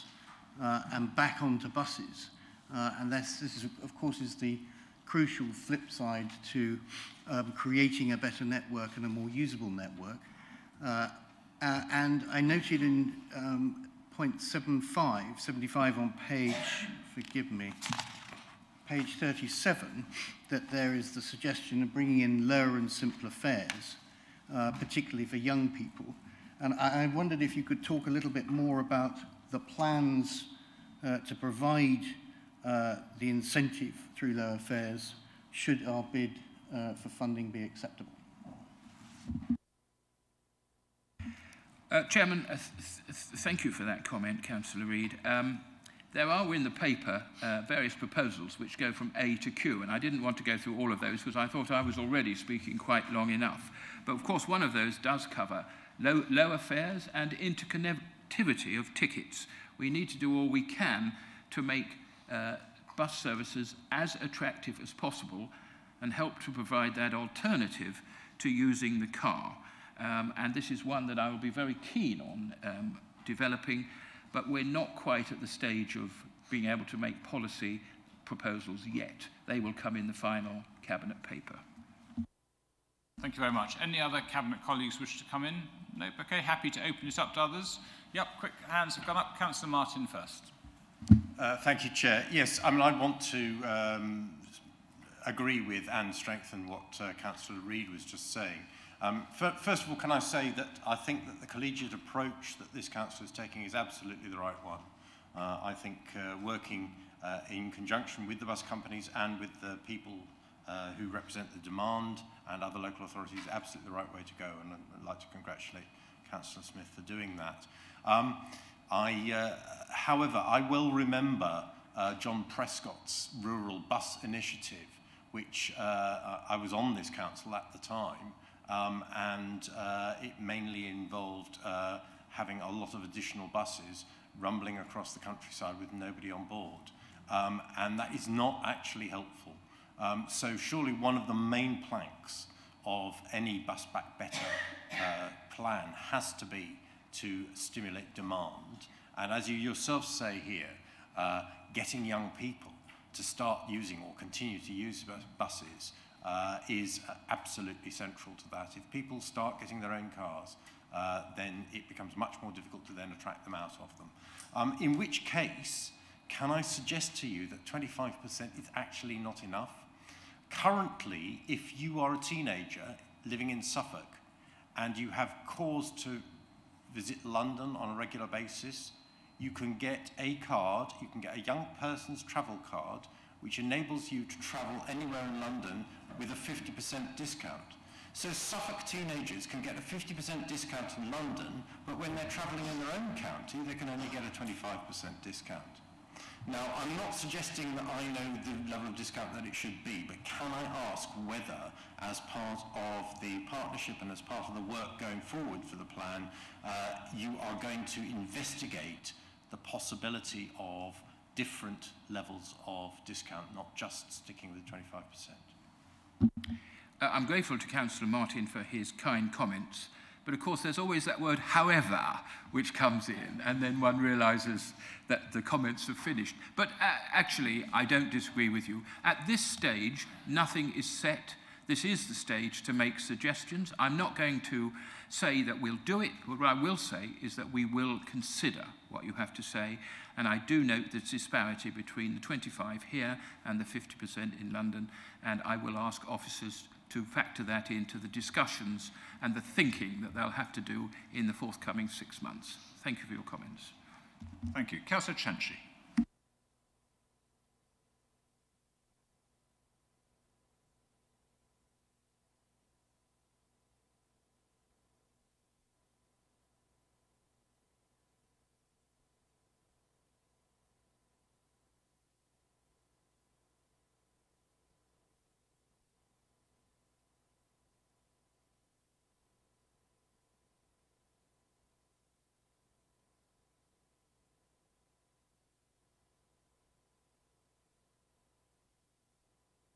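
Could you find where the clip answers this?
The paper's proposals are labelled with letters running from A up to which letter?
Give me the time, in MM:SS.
00:49.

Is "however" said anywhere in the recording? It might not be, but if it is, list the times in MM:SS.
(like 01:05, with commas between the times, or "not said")
01:59, 03:41.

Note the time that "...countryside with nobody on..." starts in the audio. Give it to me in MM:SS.
02:15.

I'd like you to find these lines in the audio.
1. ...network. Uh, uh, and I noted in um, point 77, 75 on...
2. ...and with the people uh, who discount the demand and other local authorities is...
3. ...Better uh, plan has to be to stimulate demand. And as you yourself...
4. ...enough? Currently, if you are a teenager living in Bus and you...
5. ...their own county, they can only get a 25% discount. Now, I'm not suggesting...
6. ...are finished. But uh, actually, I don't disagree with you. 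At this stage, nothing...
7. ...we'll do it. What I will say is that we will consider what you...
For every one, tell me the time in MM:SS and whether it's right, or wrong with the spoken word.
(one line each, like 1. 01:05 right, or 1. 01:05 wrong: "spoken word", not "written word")
1. 00:09 wrong: "75", not "77"
2. 01:49 wrong: "represent", not "discount"
3. 02:24 right
4. 02:49 wrong: "Suffolk", not "Bus"
5. 03:12 right
6. 03:45 right
7. 03:55 right.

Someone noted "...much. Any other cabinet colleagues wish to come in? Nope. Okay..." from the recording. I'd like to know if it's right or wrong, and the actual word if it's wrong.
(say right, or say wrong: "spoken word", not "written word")
right.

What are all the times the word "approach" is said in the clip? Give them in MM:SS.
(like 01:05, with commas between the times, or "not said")
01:41.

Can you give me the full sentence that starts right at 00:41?
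Uh, Chairman, uh, th th thank you for that comment, Councillor Reid.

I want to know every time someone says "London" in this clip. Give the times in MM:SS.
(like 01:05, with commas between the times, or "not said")
02:57, 03:05, 03:11, 04:04.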